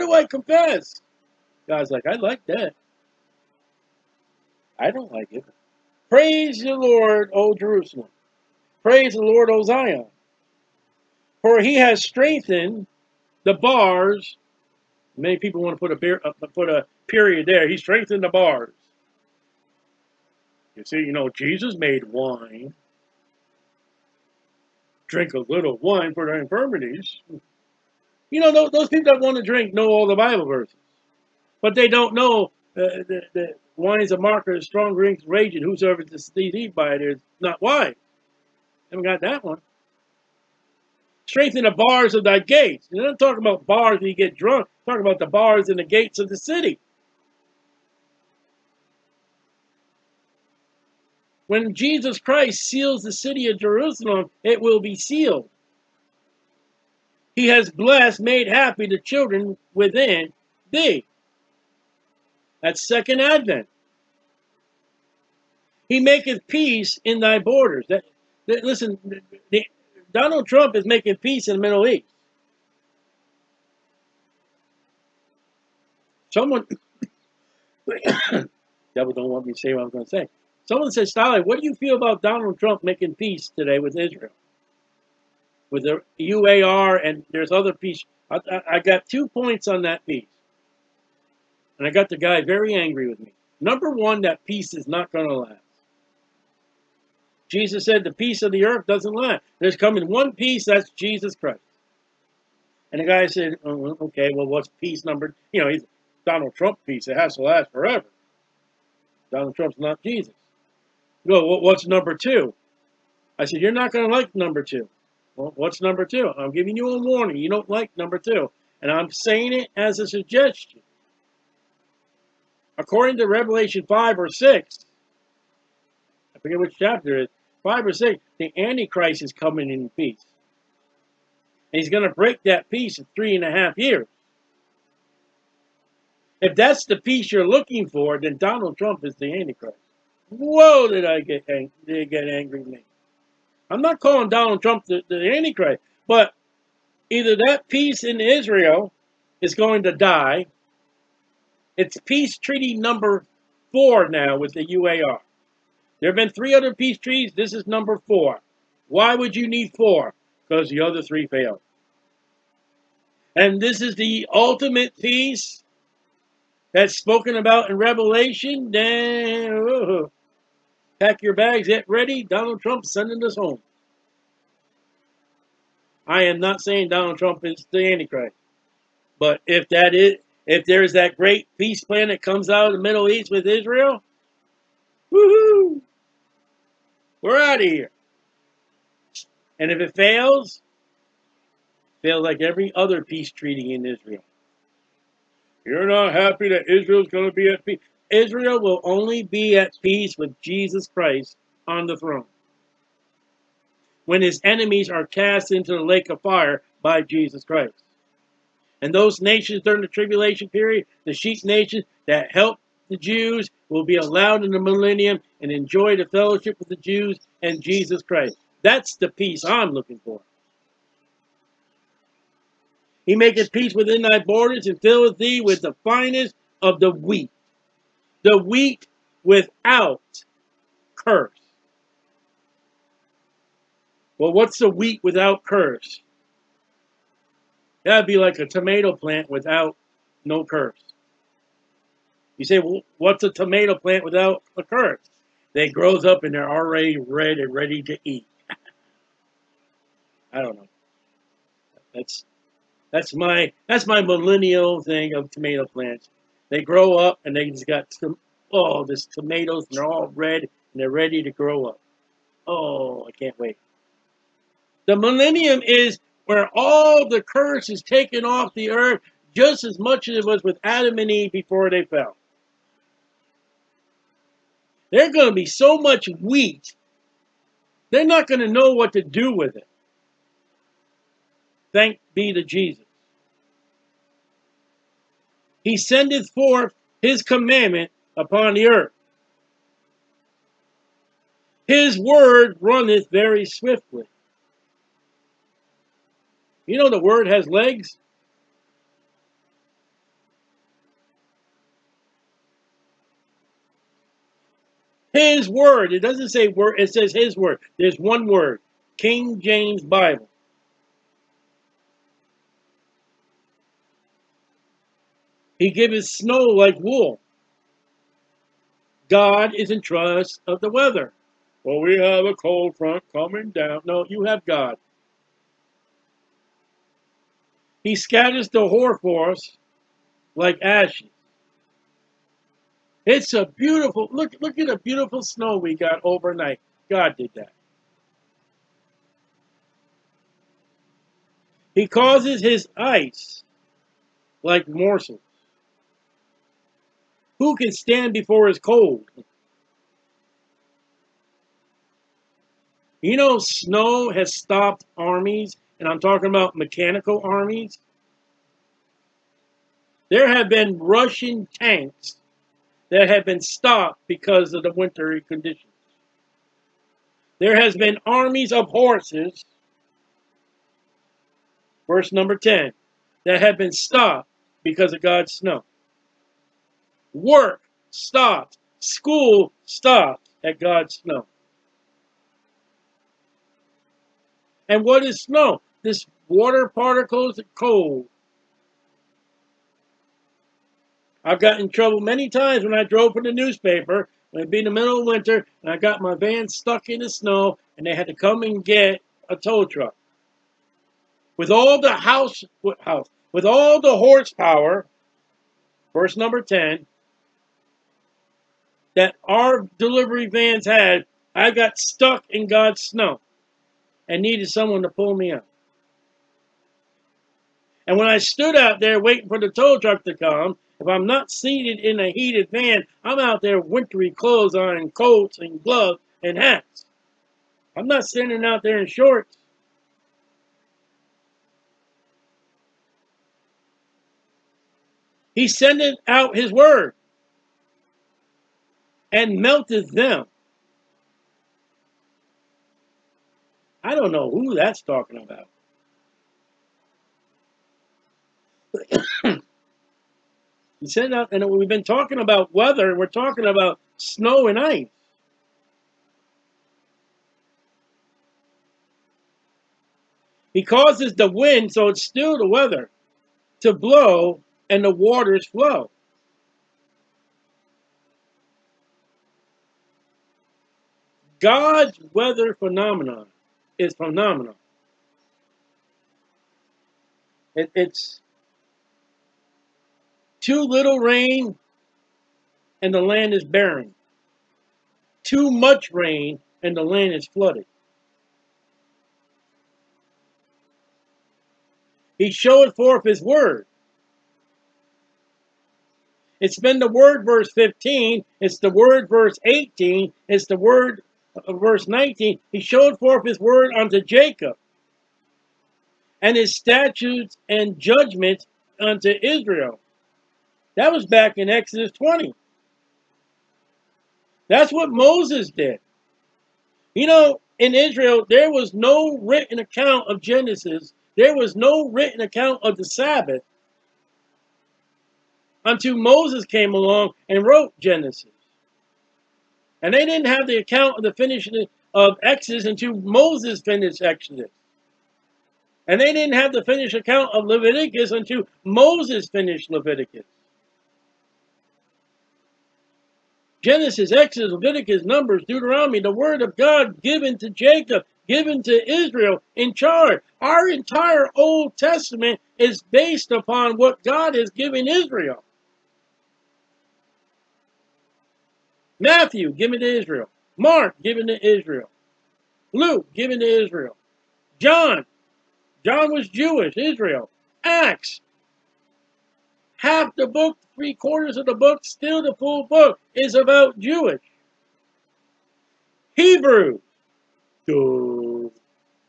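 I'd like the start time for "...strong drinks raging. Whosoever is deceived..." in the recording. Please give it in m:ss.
0:34.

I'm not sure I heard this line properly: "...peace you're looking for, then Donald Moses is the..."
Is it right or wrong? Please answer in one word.
wrong.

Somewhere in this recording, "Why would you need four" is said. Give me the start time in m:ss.
2:38.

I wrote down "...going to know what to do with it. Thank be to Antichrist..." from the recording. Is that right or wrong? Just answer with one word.
wrong.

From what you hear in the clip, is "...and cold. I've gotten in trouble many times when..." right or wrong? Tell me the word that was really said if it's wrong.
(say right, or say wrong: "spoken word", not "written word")
right.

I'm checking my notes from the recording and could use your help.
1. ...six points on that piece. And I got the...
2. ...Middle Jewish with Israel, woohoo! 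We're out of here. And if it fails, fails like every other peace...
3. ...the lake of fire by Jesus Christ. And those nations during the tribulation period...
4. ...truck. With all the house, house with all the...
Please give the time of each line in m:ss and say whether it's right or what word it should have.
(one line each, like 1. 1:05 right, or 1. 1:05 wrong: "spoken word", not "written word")
1. 1:29 wrong: "two", not "six"
2. 3:02 wrong: "East", not "Jewish"
3. 3:25 right
4. 6:39 right.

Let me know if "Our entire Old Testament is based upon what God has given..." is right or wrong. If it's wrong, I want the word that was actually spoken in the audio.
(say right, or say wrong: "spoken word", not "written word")
right.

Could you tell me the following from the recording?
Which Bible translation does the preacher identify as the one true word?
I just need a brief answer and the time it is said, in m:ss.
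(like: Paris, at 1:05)
King James Bible, at 5:08.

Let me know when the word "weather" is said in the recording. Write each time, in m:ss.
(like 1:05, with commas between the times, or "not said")
5:20, 7:32, 7:42, 7:52.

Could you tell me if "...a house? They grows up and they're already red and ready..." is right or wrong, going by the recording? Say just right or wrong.
wrong.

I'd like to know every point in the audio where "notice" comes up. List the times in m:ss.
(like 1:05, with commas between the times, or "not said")
not said.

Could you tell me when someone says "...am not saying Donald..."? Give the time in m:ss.
2:56.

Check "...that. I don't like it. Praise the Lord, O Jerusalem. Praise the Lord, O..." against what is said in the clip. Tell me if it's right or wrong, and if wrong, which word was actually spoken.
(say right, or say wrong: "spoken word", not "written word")
right.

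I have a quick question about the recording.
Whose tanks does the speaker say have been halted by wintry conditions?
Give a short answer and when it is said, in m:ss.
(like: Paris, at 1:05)
Russian, at 6:00.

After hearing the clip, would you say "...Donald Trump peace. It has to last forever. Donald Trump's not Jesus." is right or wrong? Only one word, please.
right.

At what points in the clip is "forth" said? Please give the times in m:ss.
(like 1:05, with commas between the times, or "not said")
4:46, 8:12, 8:22.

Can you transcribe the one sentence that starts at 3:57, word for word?
That'd be like a tomato plant without no curse.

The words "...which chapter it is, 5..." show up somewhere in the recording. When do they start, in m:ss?
2:06.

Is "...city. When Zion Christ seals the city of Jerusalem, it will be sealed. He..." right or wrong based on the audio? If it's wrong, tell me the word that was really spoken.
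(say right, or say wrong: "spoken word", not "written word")
wrong: "Jesus", not "Zion".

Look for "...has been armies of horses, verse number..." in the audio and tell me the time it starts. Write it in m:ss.
6:07.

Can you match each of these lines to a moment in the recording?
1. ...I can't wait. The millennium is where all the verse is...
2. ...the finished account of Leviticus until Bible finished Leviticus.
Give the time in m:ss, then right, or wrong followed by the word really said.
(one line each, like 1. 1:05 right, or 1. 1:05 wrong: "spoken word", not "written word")
1. 4:23 wrong: "curse", not "verse"
2. 8:56 wrong: "Moses", not "Bible".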